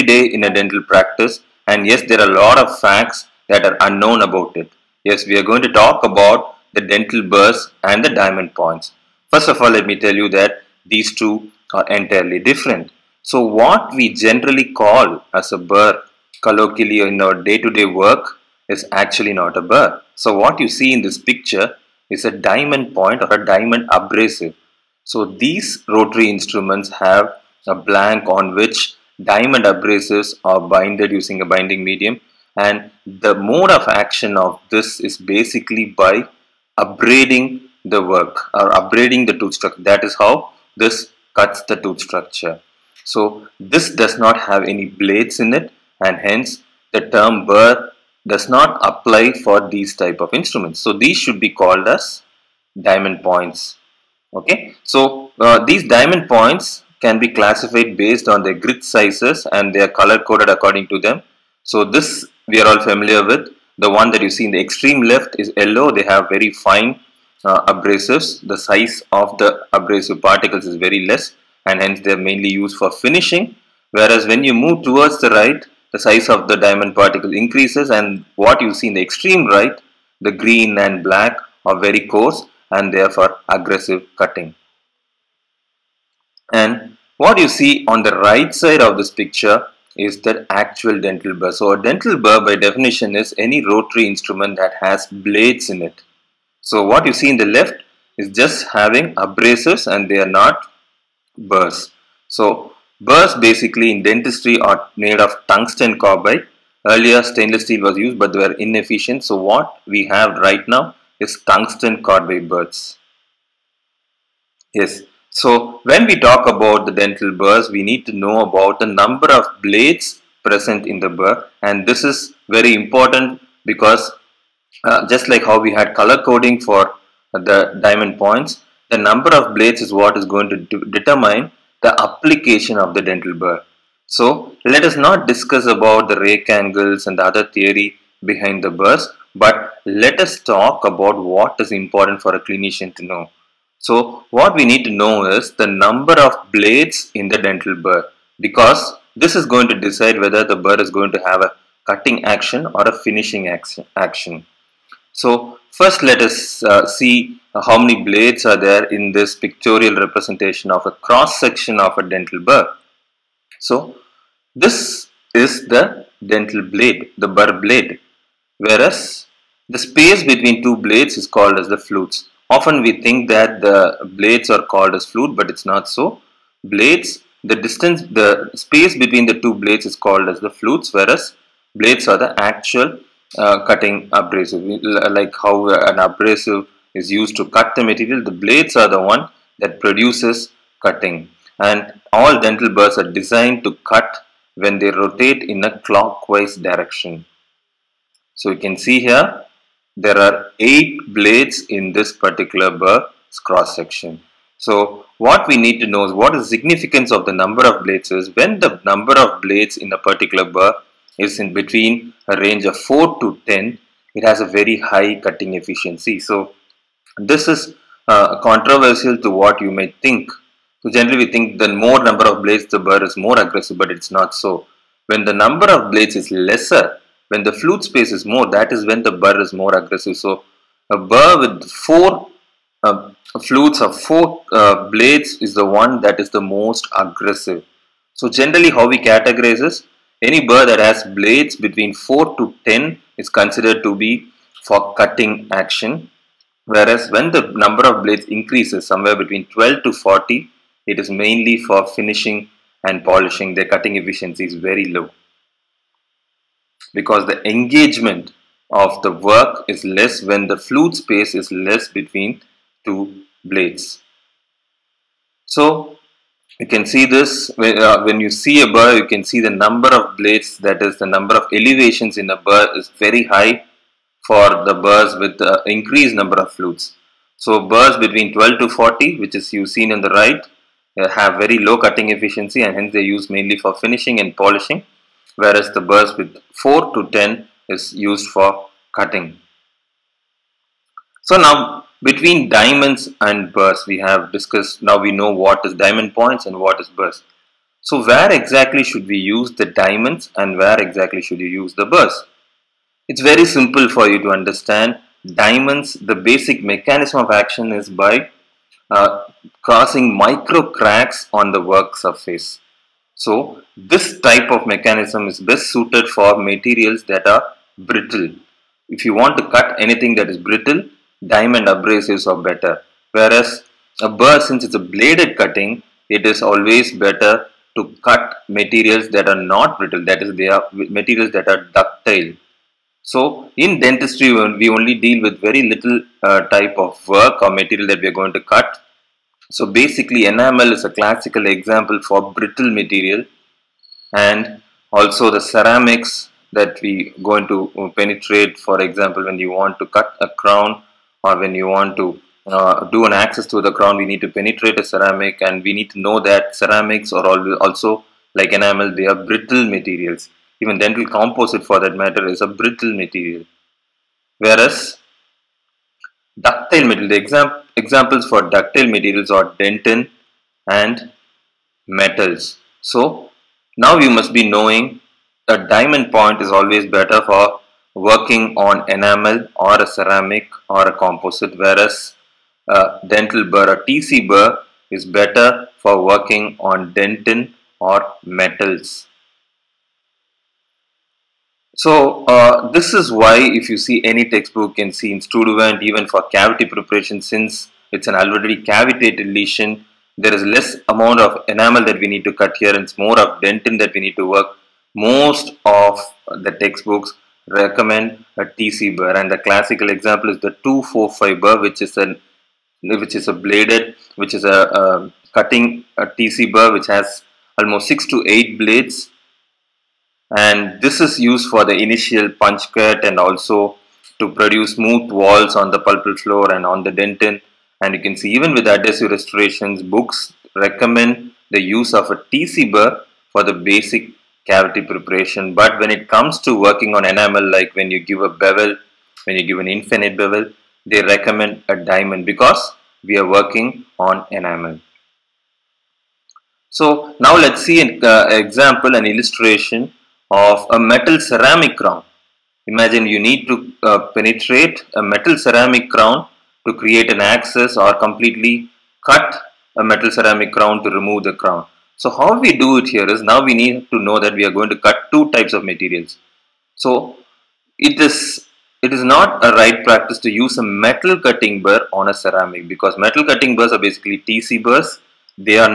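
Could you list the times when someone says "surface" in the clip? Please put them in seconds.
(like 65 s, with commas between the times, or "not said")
311 s.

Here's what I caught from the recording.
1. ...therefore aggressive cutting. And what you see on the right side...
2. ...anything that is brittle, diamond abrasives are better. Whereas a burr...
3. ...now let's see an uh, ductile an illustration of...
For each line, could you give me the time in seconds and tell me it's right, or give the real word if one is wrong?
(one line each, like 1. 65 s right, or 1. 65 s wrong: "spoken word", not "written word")
1. 82 s right
2. 319 s right
3. 447 s wrong: "example", not "ductile".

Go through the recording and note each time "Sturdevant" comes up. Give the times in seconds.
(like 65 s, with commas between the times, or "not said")
395 s.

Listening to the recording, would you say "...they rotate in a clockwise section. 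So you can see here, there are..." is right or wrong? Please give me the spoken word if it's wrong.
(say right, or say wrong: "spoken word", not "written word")
wrong: "direction", not "section".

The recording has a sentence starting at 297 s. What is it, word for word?
So where exactly should we use the diamonds and where exactly should you use the burrs?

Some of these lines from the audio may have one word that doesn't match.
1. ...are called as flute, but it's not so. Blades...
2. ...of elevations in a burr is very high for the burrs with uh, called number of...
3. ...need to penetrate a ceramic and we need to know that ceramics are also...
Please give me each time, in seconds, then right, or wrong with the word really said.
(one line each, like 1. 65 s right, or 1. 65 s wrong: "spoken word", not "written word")
1. 174 s right
2. 271 s wrong: "increased", not "called"
3. 354 s right.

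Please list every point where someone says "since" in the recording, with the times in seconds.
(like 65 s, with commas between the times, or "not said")
324 s, 397 s.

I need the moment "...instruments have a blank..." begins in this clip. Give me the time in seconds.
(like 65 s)
26 s.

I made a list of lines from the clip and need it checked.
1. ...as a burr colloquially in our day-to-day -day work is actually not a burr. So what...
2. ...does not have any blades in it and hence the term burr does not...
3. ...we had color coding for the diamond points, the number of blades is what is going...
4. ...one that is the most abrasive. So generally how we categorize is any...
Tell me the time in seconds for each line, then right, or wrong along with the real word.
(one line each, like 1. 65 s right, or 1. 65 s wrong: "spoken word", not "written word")
1. 15 s right
2. 43 s right
3. 125 s right
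4. 235 s wrong: "aggressive", not "abrasive".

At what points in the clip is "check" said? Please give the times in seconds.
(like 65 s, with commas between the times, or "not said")
not said.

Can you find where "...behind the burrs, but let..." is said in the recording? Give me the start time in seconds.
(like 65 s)
138 s.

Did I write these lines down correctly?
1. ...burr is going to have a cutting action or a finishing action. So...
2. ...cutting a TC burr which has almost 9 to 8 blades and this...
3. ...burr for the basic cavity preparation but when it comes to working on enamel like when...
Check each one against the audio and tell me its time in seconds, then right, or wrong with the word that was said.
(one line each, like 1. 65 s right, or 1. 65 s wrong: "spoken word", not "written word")
1. 150 s right
2. 415 s wrong: "6", not "9"
3. 432 s right.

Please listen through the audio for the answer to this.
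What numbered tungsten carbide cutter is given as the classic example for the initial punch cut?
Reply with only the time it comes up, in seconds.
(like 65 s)
410 s.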